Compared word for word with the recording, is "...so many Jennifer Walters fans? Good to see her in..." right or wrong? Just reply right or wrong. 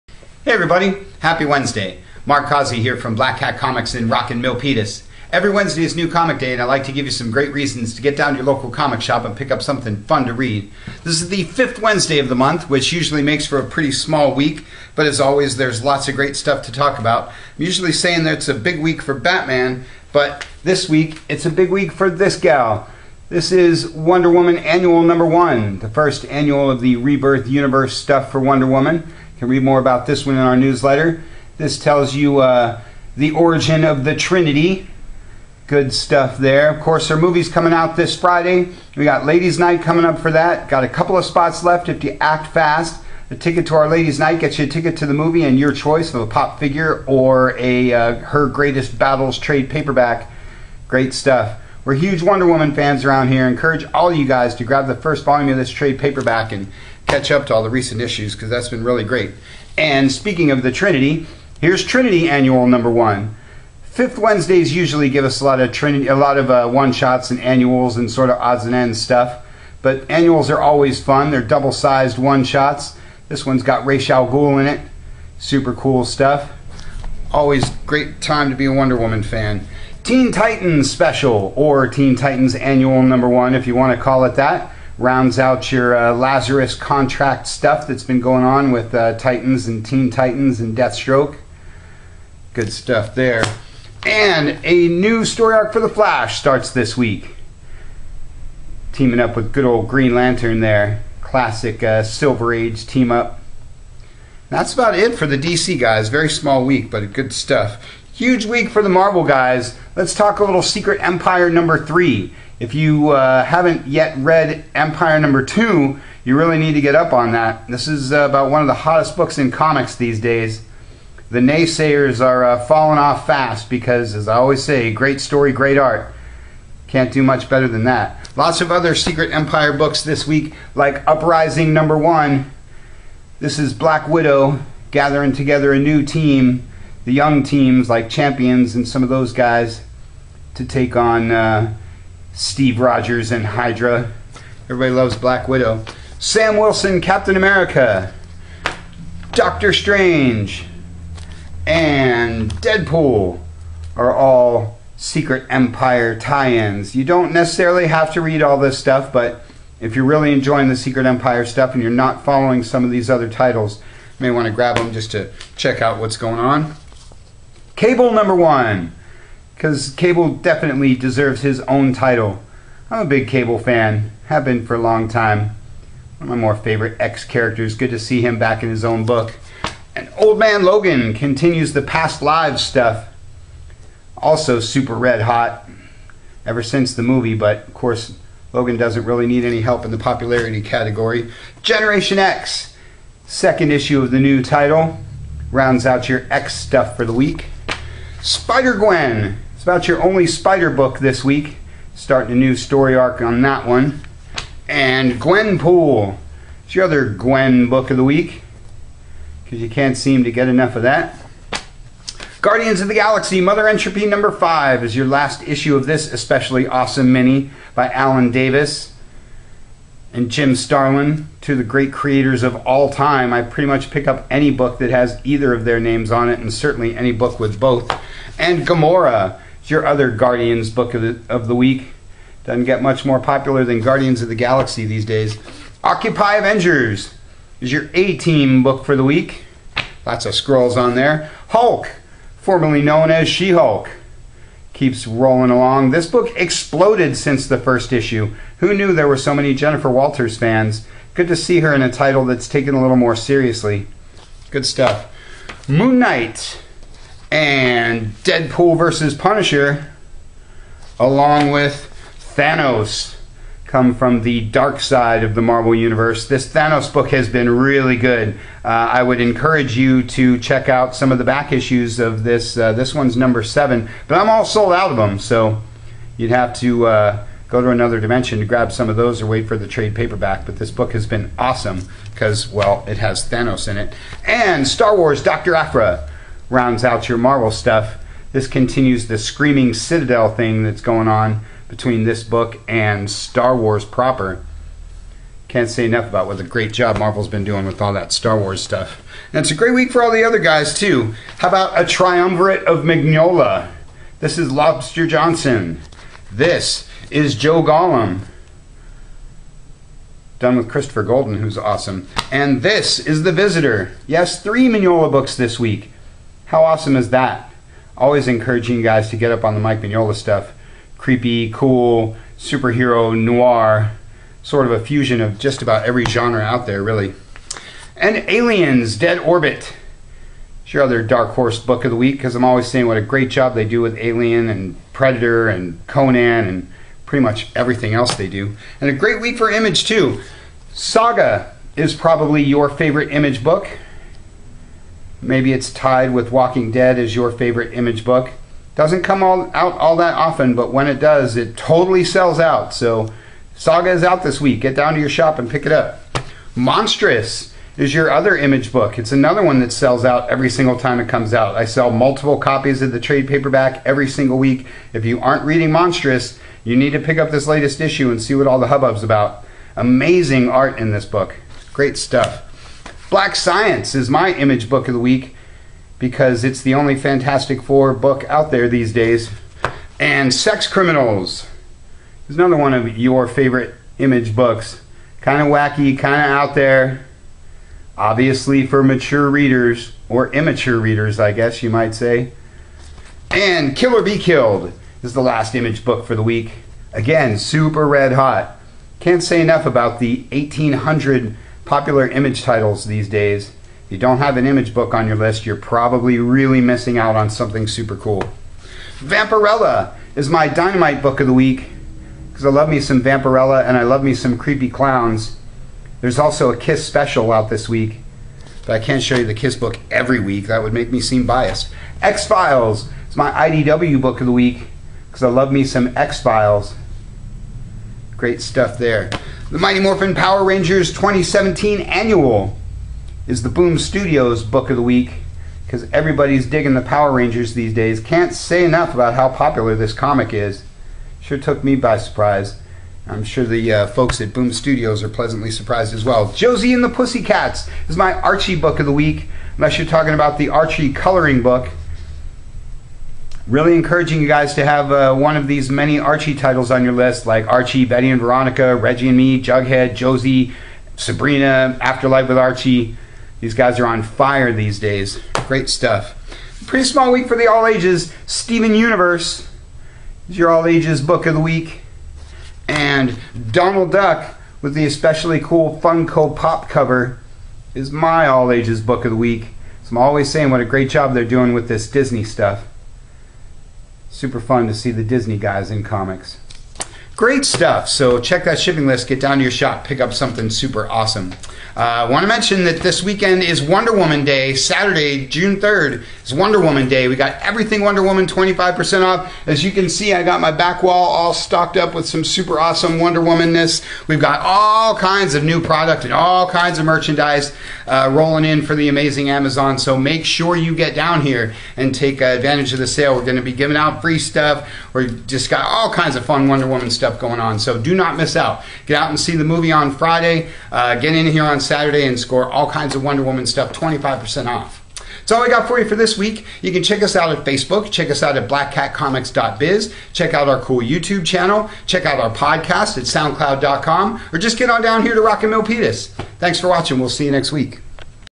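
right.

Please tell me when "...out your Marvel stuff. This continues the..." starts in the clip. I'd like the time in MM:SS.
04:46.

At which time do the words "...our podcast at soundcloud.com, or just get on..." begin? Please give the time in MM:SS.
08:52.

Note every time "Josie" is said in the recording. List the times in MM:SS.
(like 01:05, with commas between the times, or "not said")
07:26, 07:39.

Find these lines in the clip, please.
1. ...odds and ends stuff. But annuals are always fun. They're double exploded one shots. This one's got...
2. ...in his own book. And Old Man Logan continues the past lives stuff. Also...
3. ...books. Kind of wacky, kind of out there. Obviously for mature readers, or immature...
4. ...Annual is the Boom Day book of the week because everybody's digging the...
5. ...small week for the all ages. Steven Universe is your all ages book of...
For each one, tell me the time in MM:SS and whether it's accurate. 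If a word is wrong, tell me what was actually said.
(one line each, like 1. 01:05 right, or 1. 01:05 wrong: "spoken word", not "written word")
1. 01:08 wrong: "sized", not "exploded"
2. 02:58 right
3. 06:24 right
4. 07:11 wrong: "Studios", not "Day"
5. 07:46 right.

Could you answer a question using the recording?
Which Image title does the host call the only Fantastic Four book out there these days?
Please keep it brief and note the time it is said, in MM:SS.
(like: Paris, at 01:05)
Black Science, at 06:13.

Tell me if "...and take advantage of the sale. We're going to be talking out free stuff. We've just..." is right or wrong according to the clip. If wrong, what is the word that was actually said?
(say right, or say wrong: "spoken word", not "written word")
wrong: "giving", not "talking".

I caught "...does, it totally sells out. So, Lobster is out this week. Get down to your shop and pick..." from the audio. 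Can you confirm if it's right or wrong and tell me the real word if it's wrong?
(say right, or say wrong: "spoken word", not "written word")
wrong: "Saga", not "Lobster".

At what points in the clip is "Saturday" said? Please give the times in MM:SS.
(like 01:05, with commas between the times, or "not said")
08:14, 08:41.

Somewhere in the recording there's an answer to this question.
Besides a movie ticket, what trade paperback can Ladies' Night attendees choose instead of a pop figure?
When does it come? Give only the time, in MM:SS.
00:48.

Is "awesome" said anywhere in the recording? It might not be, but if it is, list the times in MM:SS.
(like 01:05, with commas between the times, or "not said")
03:36, 04:41, 05:11, 05:16, 08:10, 08:22.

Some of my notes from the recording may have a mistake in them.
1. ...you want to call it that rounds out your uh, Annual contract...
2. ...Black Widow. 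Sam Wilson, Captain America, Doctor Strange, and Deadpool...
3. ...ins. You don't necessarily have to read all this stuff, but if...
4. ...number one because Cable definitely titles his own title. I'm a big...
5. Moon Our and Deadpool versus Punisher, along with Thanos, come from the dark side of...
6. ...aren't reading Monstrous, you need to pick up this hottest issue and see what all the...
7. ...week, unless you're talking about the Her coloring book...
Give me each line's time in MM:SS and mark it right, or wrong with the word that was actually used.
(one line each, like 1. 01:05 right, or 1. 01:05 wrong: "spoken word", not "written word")
1. 01:23 wrong: "Lazarus", not "Annual"
2. 02:25 right
3. 02:36 right
4. 02:48 wrong: "deserves", not "titles"
5. 04:15 wrong: "Knight", not "Our"
6. 06:05 wrong: "latest", not "hottest"
7. 07:28 wrong: "Archie", not "Her".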